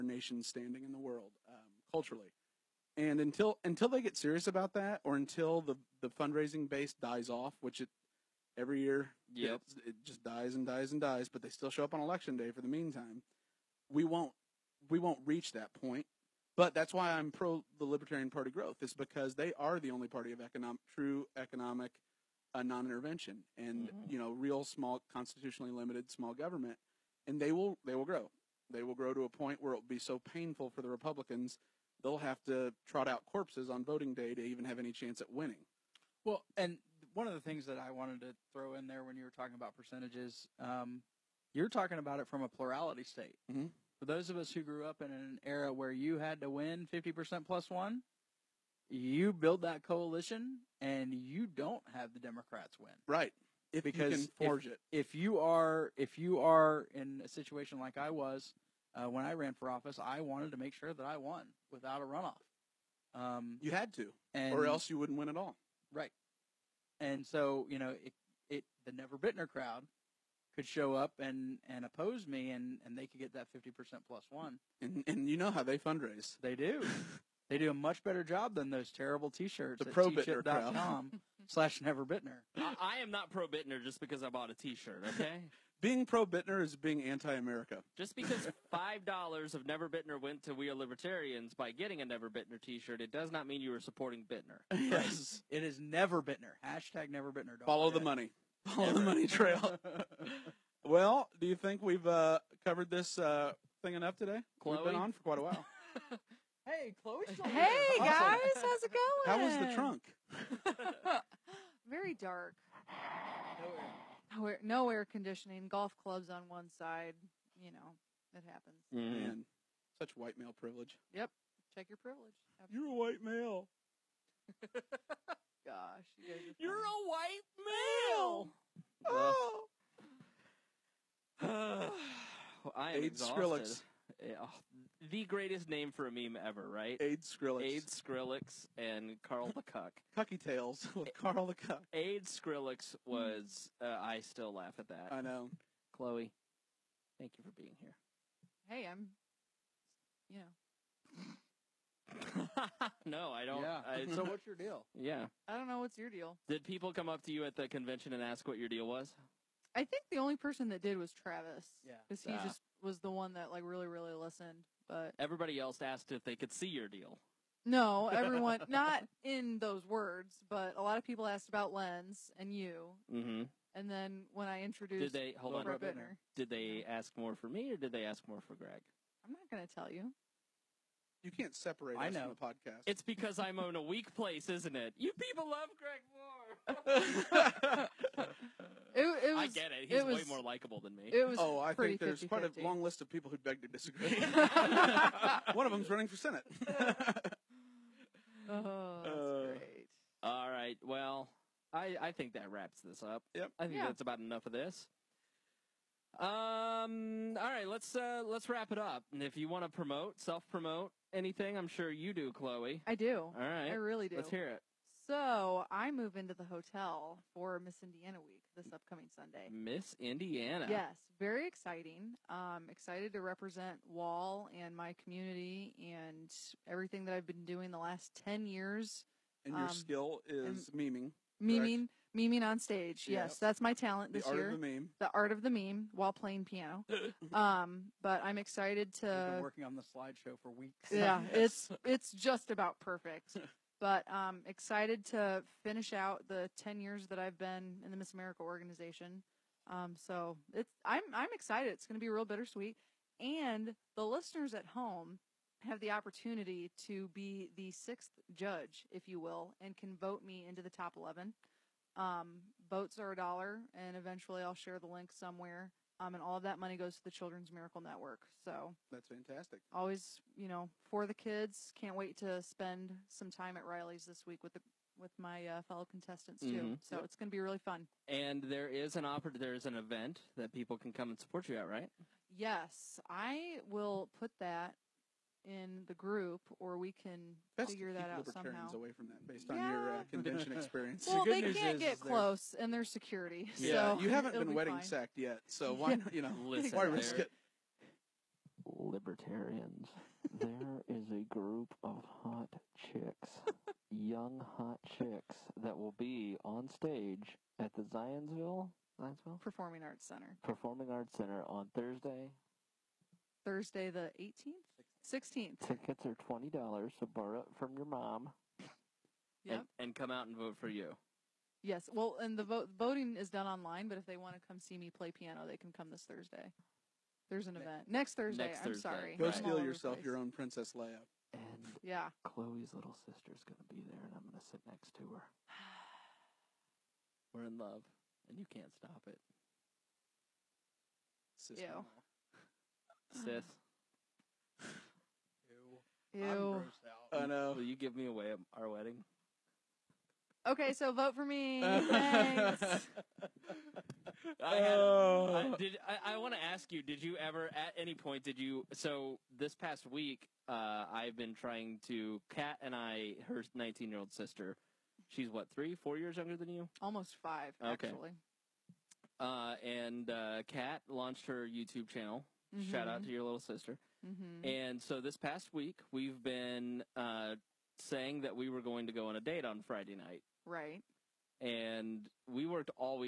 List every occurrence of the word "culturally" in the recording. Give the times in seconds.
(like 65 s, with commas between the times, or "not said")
1 s.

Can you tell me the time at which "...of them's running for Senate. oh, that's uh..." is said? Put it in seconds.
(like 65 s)
195 s.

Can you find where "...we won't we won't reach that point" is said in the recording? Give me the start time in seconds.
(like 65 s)
13 s.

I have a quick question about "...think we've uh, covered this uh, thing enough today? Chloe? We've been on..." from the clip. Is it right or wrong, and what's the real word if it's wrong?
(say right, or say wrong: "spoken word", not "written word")
right.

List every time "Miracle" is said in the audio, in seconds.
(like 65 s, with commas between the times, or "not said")
267 s.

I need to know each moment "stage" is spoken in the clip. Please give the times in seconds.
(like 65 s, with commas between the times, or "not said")
232 s, 306 s.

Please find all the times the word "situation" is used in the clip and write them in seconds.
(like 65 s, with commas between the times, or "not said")
57 s.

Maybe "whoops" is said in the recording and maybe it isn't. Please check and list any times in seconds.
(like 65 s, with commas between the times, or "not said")
not said.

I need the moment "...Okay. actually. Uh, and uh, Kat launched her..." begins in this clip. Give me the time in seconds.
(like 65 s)
367 s.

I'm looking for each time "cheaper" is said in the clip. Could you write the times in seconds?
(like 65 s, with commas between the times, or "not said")
not said.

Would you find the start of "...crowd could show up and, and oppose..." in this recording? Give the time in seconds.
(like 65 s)
69 s.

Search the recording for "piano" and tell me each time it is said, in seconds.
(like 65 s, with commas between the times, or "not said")
236 s, 325 s.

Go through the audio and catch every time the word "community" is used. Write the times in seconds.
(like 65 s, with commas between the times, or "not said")
225 s.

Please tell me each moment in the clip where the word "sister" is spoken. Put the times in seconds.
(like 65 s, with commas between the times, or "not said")
333 s, 364 s, 373 s.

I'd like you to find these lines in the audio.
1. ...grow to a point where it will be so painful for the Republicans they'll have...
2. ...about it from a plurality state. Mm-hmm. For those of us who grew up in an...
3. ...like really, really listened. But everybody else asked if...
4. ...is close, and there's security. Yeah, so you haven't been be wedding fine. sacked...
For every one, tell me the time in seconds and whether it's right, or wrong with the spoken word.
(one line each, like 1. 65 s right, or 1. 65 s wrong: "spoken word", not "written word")
1. 28 s right
2. 41 s right
3. 163 s right
4. 291 s right.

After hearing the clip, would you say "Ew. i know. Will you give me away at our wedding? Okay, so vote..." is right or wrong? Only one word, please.
right.